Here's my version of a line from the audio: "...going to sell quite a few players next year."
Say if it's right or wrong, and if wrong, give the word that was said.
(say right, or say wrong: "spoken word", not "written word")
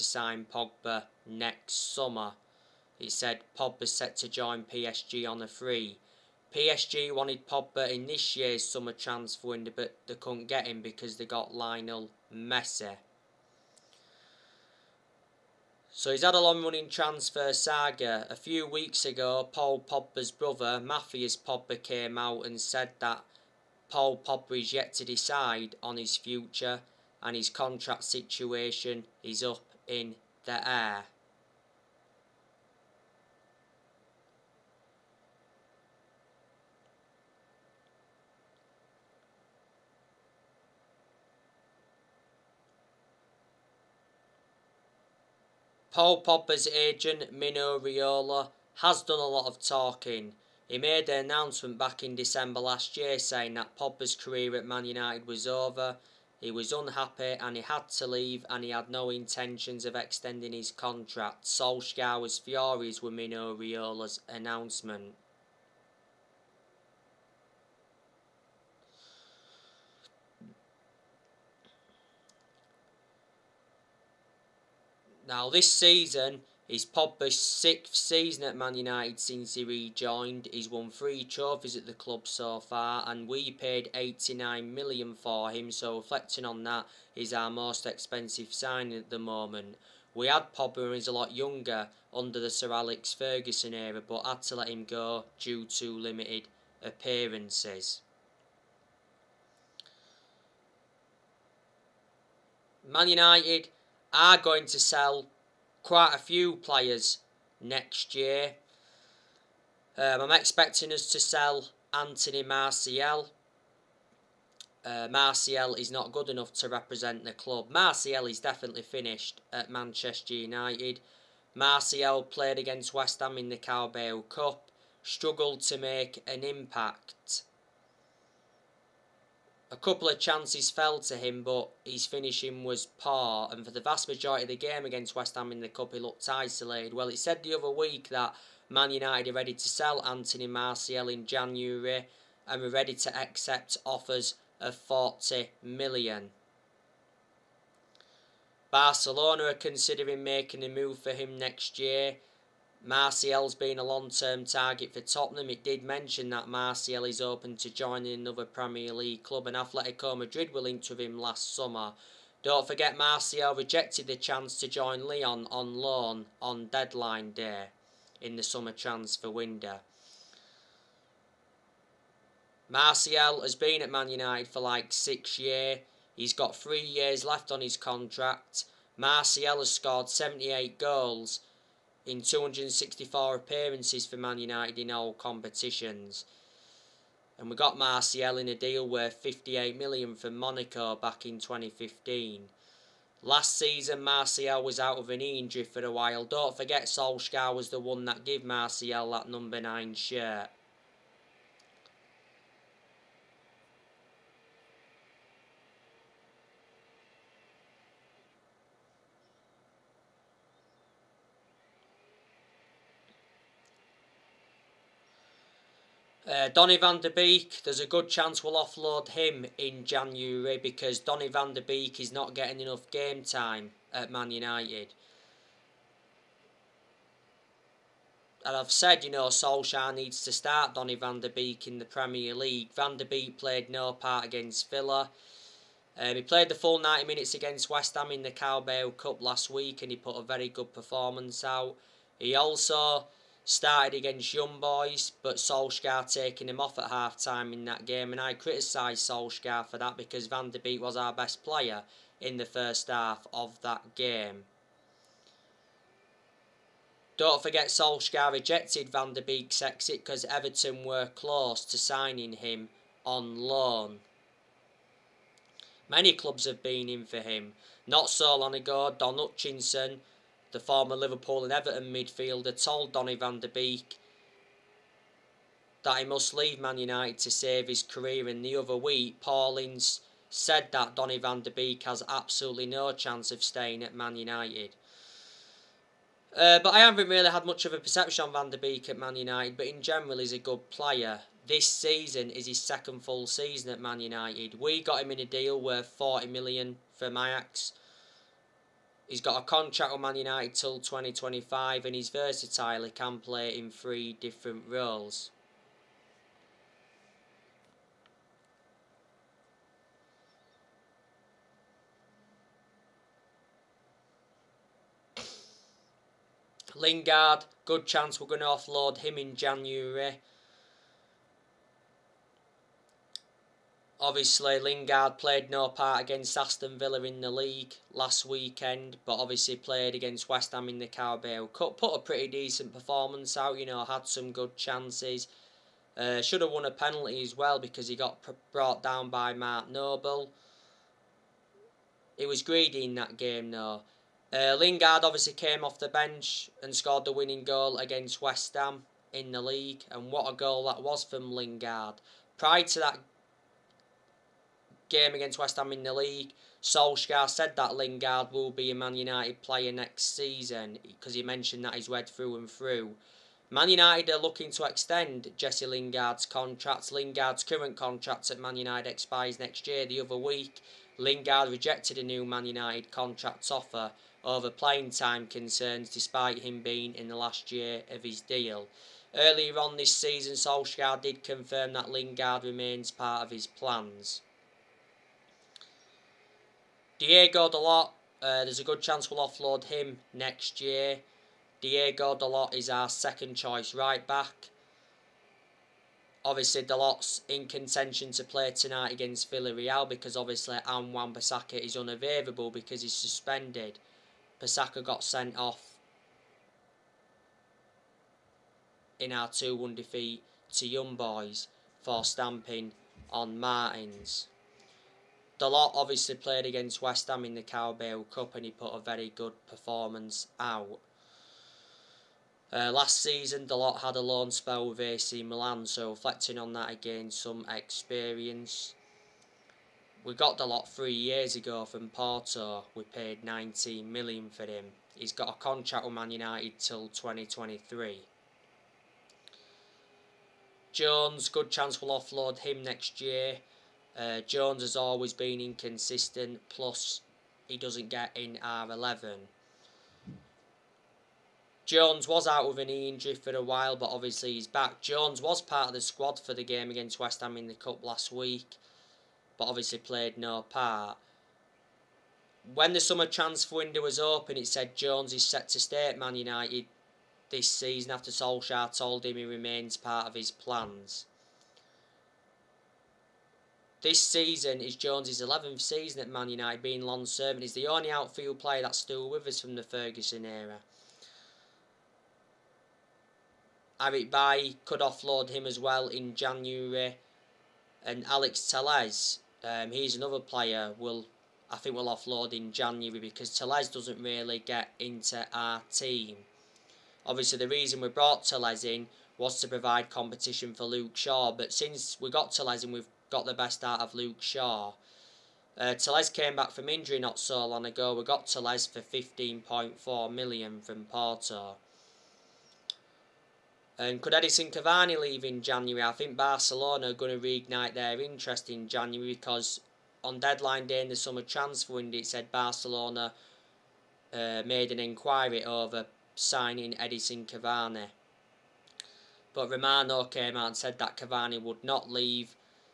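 right.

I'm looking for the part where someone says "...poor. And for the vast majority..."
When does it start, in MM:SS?
02:12.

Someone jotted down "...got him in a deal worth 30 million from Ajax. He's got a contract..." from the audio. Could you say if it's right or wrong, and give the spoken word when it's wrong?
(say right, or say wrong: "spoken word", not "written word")
wrong: "40", not "30".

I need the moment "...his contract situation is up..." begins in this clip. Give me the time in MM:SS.
00:27.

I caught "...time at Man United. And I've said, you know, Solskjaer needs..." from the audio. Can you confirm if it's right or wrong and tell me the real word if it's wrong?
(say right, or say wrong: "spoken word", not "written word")
right.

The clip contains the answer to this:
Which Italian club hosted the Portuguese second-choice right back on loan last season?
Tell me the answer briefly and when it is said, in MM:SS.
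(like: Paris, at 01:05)
AC Milan, at 07:04.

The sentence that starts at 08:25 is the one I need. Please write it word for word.
Uh, Telles came back from injury not so long ago.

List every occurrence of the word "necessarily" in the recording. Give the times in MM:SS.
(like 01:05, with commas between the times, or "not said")
not said.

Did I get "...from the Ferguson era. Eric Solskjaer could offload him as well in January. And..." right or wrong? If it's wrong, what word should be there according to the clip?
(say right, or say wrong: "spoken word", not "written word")
wrong: "Bailly", not "Solskjaer".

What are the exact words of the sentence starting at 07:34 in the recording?
Jones was part of the squad for the game against West Ham in the Cup last week, but obviously played no part.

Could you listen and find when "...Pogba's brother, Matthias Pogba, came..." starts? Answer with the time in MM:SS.
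00:19.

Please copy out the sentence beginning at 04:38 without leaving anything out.
In the other week, Paulins said that Donny van de Beek has absolutely no chance of staying at Man United.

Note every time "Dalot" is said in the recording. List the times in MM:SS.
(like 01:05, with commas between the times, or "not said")
06:27, 06:32, 06:36, 06:55, 07:03, 07:10.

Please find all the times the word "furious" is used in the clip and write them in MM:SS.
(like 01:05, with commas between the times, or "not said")
01:02.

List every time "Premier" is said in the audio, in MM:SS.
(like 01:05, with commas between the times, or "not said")
02:38, 03:51.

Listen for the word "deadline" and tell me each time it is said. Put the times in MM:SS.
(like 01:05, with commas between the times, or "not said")
02:46, 08:40.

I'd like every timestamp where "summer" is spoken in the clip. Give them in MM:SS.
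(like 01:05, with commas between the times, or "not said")
00:01, 00:08, 02:41, 02:48, 07:42, 08:40.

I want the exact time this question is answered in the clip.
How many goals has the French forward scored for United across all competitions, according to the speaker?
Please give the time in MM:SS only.
03:00.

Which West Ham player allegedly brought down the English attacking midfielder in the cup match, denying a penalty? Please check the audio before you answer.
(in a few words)
Mark Noble.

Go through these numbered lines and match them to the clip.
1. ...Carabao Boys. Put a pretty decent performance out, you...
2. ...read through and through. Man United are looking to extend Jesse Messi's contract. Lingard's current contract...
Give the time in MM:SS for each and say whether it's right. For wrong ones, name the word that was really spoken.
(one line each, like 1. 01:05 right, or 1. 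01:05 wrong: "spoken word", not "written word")
1. 05:30 wrong: "Cup", not "Boys"
2. 06:01 wrong: "Lingard", not "Messi".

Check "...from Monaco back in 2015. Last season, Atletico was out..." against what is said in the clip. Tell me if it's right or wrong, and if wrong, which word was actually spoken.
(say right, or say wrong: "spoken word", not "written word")
wrong: "Martial", not "Atletico".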